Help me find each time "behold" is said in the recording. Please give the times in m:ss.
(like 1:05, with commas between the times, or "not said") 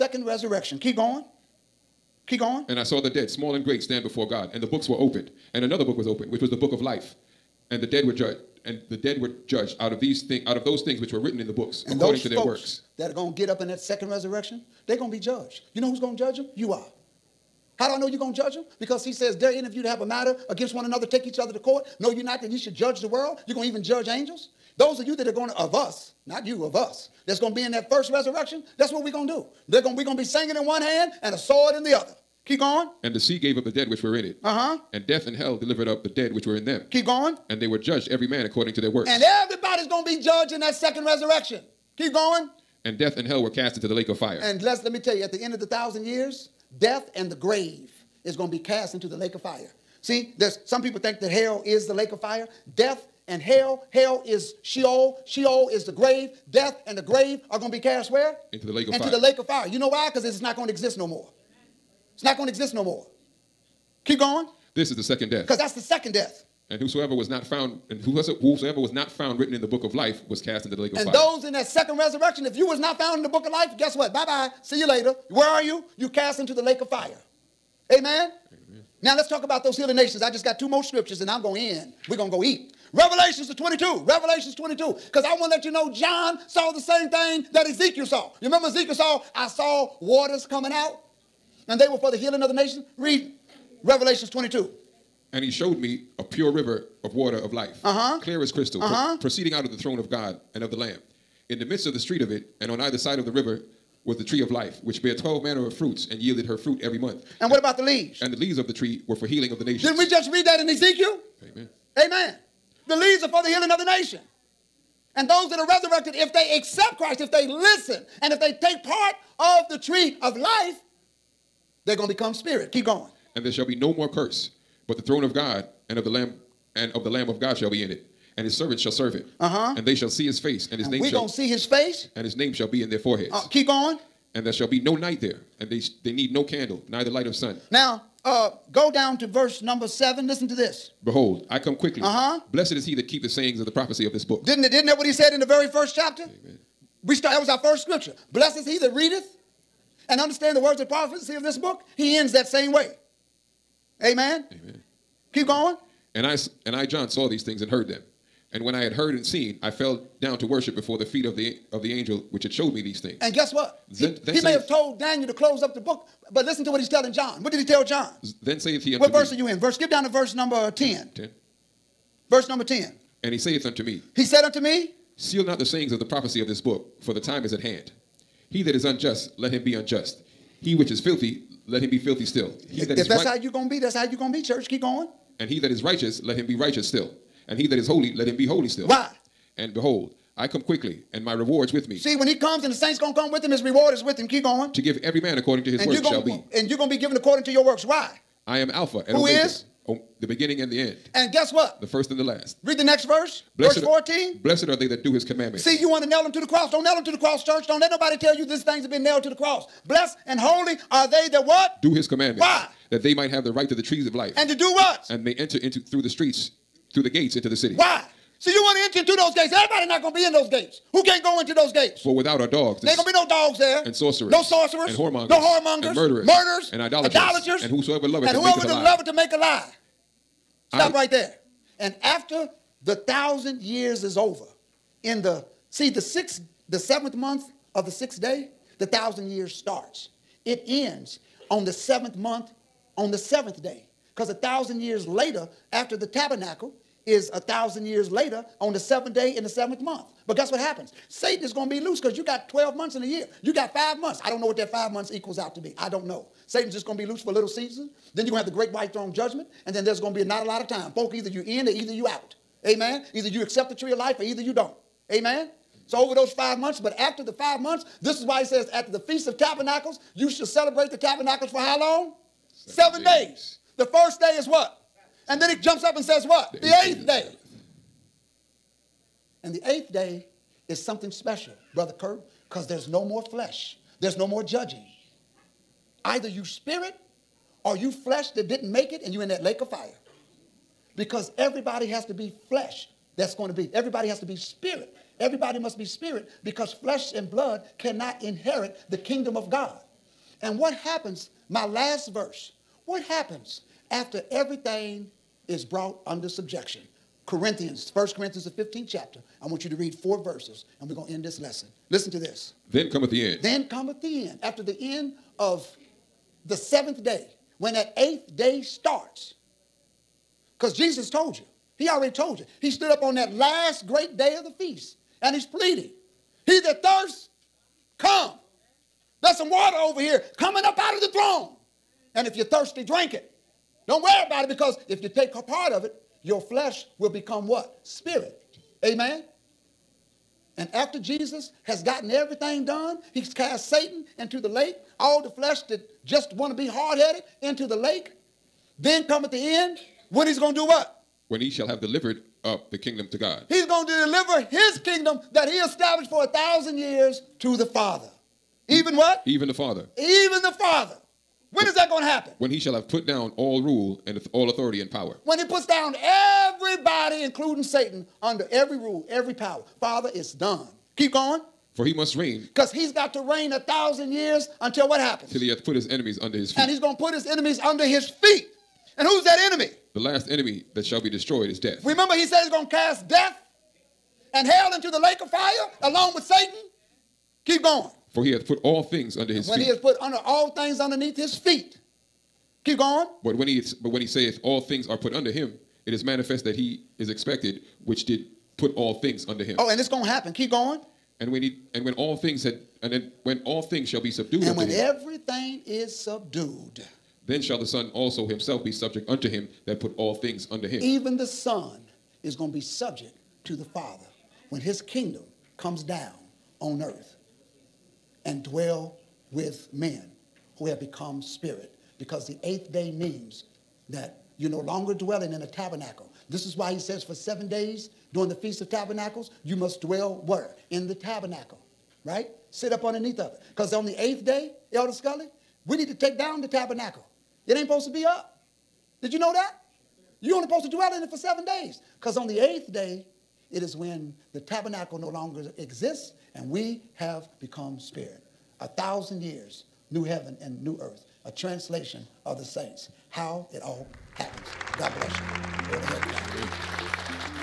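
2:21, 3:09.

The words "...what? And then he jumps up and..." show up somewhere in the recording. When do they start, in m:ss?
4:34.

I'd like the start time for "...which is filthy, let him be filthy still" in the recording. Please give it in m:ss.
3:00.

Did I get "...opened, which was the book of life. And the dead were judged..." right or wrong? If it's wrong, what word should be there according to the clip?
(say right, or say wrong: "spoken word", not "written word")
right.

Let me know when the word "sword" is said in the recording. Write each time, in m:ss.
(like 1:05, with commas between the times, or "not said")
0:31.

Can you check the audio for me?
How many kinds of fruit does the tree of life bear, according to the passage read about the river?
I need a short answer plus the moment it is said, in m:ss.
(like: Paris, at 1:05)
12, at 1:45.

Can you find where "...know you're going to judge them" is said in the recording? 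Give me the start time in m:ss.
0:17.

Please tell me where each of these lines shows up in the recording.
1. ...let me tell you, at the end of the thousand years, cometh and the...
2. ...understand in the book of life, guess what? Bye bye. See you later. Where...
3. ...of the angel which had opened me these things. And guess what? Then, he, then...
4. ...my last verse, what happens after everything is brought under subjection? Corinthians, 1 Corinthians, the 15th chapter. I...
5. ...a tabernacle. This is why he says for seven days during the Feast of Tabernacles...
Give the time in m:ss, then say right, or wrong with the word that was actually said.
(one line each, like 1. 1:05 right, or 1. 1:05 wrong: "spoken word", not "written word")
1. 0:44 wrong: "death", not "cometh"
2. 1:12 wrong: "found", not "understand"
3. 2:41 wrong: "showed", not "opened"
4. 5:01 right
5. 7:05 right.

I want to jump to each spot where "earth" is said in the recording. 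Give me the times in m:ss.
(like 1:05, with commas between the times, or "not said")
6:56, 7:30.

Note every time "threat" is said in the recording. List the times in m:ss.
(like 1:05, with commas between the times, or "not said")
not said.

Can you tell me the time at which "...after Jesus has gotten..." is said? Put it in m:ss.
5:40.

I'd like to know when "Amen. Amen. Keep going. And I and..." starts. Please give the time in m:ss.
2:34.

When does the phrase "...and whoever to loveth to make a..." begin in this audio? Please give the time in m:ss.
3:48.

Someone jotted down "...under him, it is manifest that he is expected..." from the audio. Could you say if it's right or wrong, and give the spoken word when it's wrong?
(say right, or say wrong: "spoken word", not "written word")
right.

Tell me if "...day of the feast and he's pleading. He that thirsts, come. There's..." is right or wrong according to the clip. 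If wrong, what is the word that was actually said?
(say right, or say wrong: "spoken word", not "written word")
right.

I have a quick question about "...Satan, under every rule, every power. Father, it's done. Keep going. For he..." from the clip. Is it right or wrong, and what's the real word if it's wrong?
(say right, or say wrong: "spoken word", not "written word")
right.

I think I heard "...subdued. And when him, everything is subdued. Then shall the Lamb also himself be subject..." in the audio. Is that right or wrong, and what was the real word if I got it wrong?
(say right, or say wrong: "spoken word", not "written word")
wrong: "Son", not "Lamb".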